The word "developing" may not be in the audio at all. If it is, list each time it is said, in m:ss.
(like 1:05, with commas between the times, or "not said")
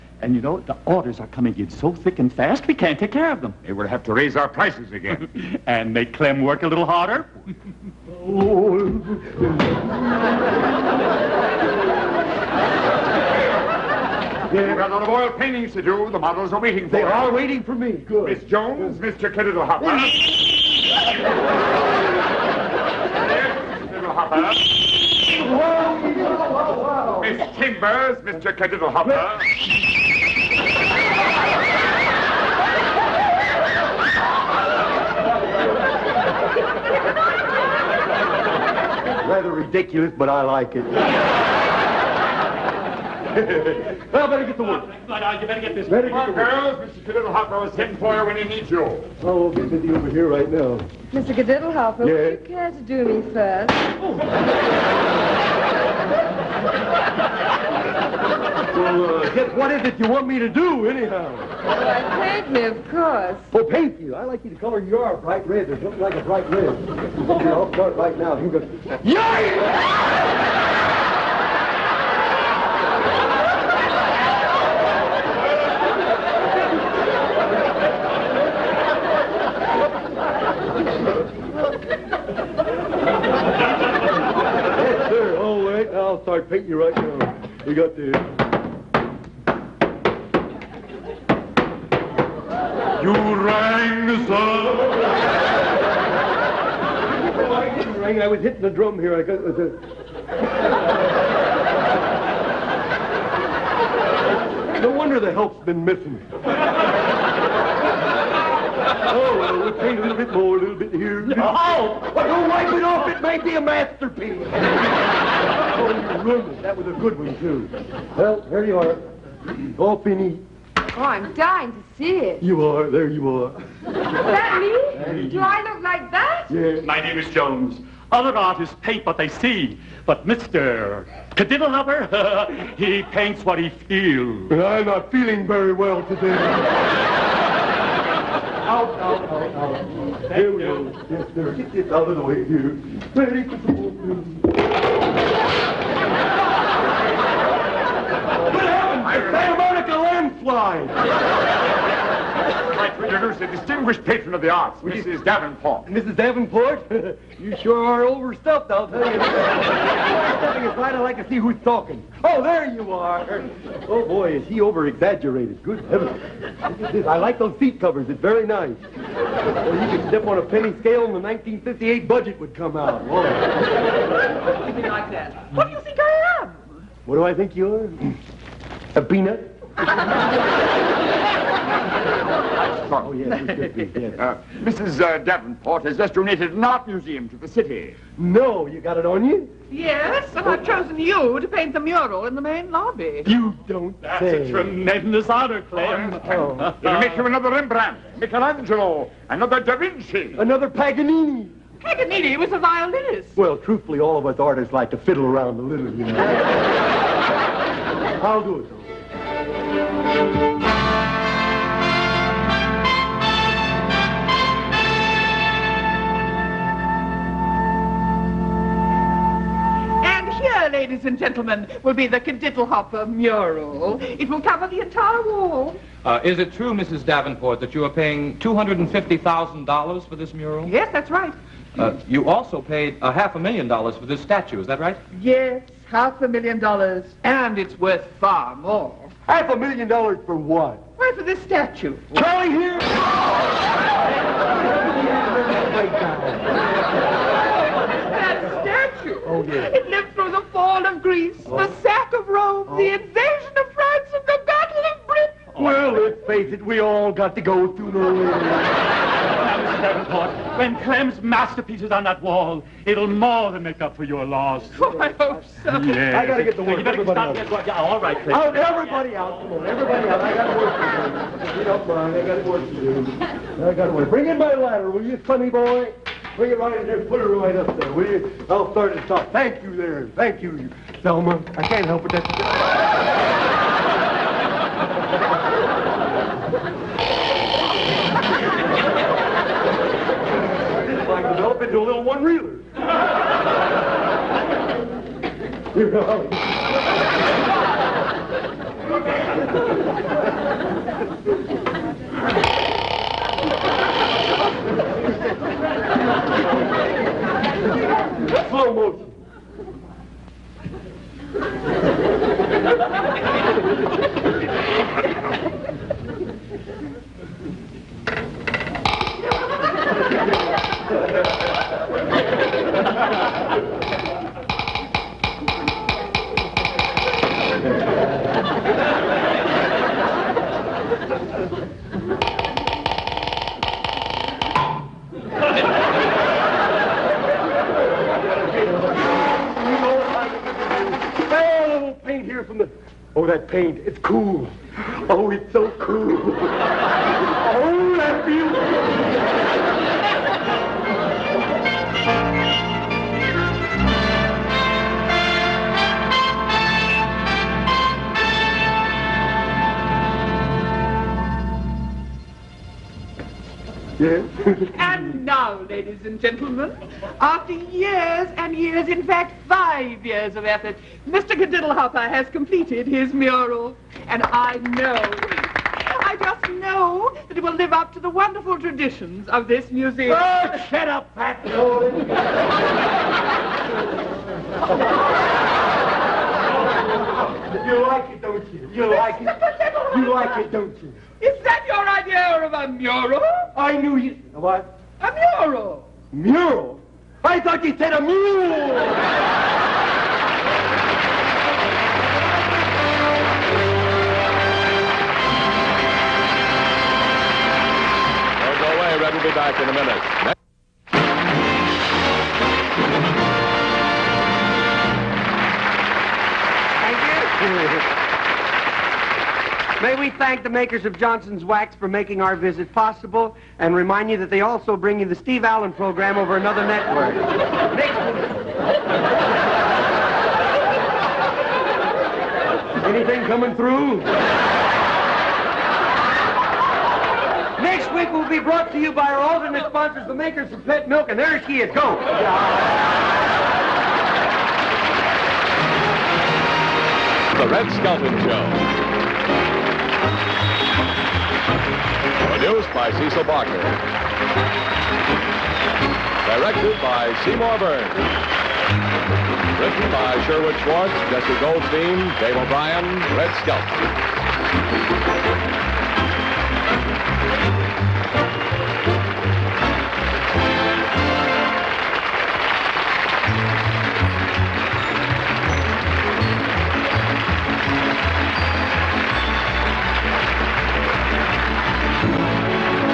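not said.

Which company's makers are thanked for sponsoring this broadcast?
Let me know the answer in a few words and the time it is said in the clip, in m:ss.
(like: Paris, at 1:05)
Johnson's Wax, at 7:00.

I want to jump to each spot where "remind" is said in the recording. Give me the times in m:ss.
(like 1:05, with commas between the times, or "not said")
7:03.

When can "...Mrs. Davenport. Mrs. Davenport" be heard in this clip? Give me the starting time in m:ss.
2:34.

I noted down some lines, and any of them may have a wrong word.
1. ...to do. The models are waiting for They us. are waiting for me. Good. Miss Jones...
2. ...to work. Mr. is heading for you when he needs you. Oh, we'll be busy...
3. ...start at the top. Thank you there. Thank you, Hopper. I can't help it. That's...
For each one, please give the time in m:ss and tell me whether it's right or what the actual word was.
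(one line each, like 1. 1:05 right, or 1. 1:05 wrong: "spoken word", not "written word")
1. 0:15 right
2. 0:46 right
3. 4:38 wrong: "Thelma", not "Hopper".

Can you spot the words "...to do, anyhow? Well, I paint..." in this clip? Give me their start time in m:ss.
1:00.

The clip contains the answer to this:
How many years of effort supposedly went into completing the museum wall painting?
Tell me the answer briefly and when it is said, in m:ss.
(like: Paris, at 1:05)
5, at 6:09.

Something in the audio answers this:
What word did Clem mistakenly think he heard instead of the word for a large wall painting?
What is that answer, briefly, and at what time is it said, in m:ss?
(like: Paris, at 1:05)
A mule, at 6:37.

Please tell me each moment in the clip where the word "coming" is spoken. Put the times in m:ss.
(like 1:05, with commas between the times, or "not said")
0:01, 7:13.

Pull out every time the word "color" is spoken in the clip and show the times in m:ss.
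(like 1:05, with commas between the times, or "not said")
1:04.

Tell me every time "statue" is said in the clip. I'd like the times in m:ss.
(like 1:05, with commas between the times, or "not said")
3:54, 4:01, 4:08.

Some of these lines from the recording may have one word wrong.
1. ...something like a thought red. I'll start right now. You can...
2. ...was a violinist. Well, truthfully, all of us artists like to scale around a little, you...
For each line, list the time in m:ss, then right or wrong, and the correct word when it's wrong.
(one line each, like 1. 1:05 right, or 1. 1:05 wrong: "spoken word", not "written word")
1. 1:05 wrong: "bright", not "thought"
2. 3:22 wrong: "fiddle", not "scale".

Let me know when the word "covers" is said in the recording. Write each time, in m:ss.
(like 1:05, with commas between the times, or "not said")
2:47, 3:44.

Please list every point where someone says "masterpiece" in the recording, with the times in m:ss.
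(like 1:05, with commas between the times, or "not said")
1:53, 4:21.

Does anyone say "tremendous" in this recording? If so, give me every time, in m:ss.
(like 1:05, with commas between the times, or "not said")
3:14.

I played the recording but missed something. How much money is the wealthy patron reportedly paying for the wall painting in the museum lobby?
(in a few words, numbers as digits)
$250,000.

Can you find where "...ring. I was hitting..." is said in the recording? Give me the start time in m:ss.
1:38.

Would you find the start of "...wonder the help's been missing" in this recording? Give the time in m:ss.
1:44.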